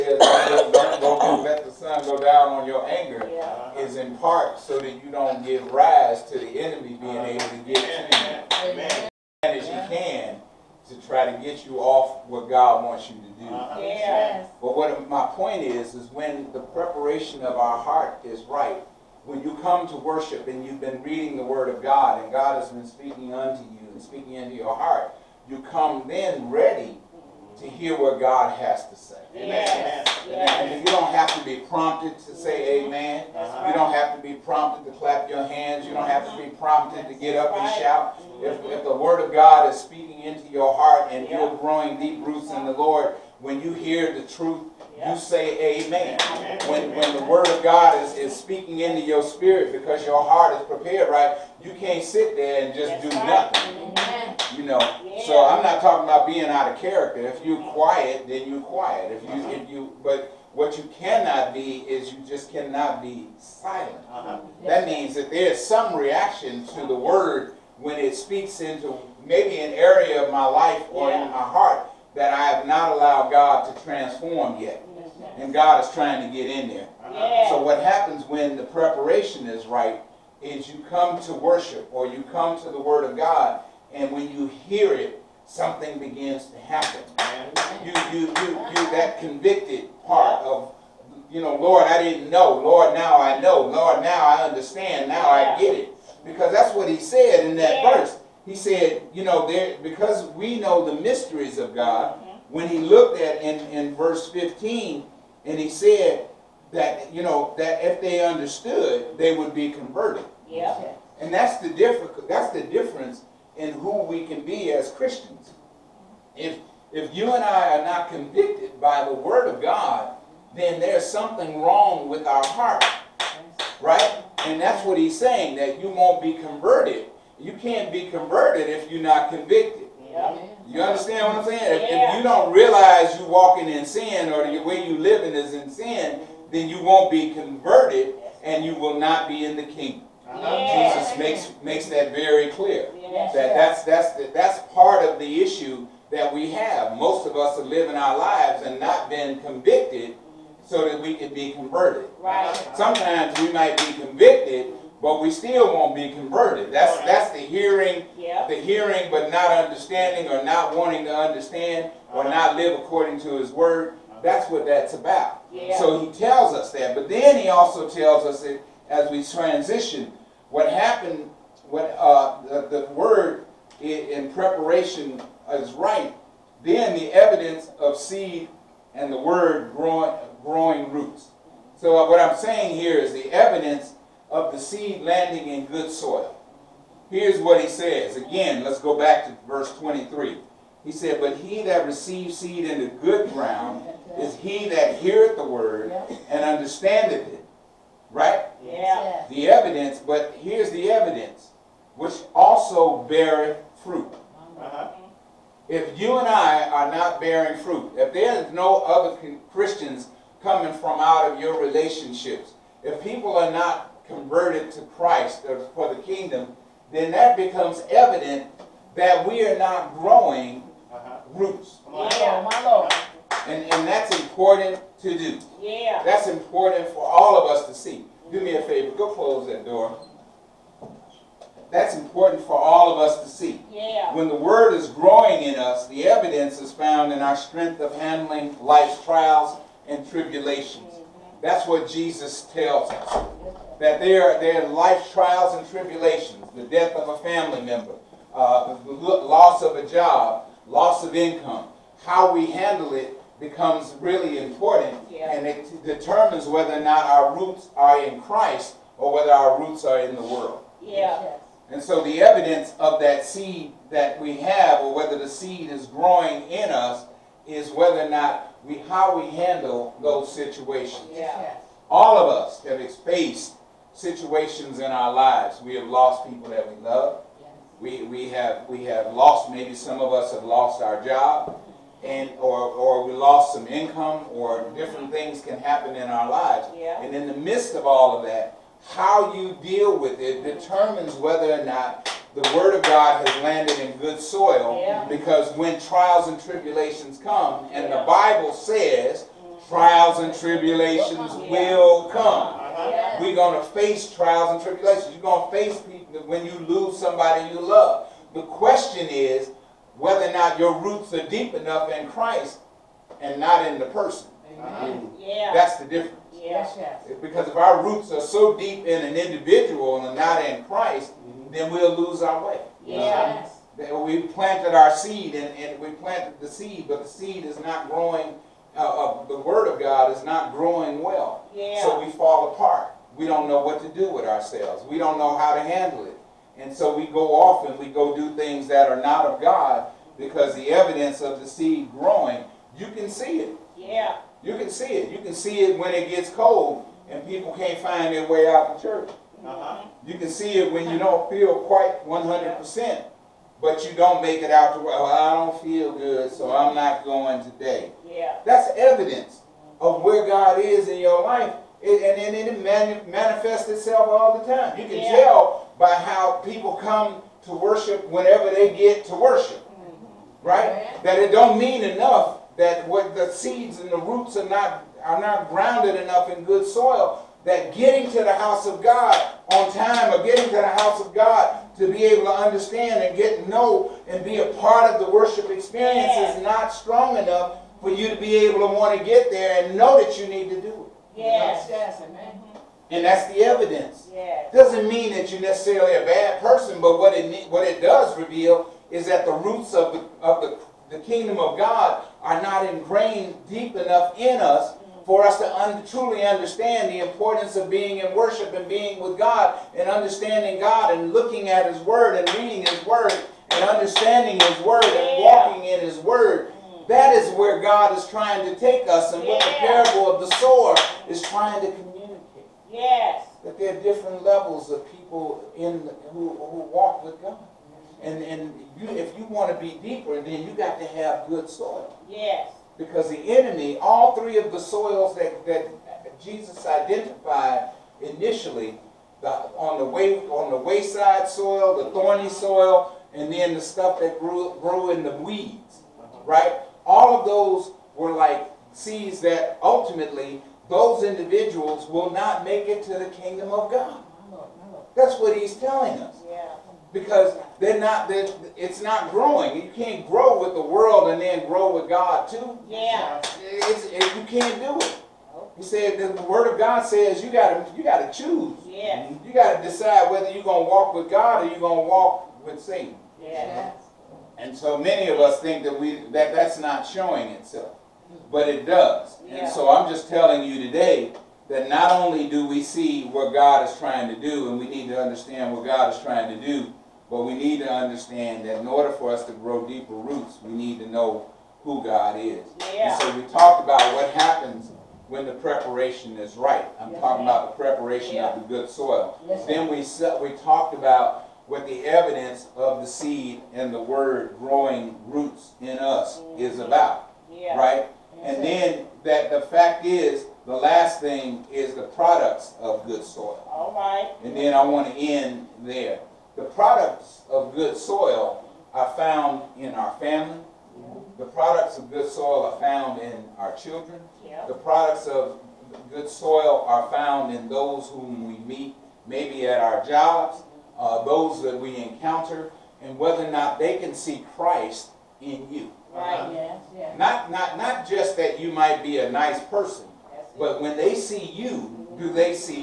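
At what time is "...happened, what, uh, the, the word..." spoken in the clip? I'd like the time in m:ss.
2:50.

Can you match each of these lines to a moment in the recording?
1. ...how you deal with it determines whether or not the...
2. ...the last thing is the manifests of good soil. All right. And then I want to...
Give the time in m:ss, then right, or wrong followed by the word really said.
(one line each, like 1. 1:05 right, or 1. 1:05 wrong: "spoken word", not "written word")
1. 4:48 right
2. 8:30 wrong: "products", not "manifests".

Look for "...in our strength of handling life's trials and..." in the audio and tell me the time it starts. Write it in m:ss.
3:57.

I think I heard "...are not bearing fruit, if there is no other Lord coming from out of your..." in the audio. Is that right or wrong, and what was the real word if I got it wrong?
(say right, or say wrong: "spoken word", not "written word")
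wrong: "Christians", not "Lord".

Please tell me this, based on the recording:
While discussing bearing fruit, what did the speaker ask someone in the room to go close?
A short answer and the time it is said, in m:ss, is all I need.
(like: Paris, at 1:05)
That door, at 3:49.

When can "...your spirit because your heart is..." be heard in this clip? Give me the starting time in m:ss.
0:49.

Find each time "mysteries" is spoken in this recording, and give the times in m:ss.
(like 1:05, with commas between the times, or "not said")
1:40.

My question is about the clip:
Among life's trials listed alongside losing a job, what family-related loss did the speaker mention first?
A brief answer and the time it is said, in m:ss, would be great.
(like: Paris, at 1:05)
Death of a family member, at 4:06.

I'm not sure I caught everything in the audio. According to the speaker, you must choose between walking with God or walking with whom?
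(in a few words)
Satan.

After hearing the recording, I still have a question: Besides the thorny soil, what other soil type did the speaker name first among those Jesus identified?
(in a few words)
Wayside soil.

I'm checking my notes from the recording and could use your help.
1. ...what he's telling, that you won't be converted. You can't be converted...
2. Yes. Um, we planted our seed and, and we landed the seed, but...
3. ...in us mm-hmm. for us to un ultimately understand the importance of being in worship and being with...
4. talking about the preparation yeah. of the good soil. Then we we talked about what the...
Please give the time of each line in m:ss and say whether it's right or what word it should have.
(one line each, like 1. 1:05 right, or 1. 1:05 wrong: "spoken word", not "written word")
1. 2:04 wrong: "saying", not "telling"
2. 5:22 wrong: "planted", not "landed"
3. 6:44 wrong: "truly", not "ultimately"
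4. 8:16 right.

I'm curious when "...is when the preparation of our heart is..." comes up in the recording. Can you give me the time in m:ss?
0:15.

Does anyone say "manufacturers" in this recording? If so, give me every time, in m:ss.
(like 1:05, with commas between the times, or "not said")
not said.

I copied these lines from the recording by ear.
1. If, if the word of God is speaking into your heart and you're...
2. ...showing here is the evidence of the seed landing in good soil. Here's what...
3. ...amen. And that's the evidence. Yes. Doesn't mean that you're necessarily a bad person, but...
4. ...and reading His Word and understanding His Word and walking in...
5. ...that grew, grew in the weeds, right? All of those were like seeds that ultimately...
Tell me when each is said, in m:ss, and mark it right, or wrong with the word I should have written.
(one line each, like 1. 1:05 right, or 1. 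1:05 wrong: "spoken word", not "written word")
1. 0:38 right
2. 3:02 wrong: "saying", not "showing"
3. 6:32 right
4. 6:52 right
5. 7:23 right.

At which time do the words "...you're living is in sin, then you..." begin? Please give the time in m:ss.
2:14.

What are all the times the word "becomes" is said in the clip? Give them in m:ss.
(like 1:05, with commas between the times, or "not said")
3:37, 4:13.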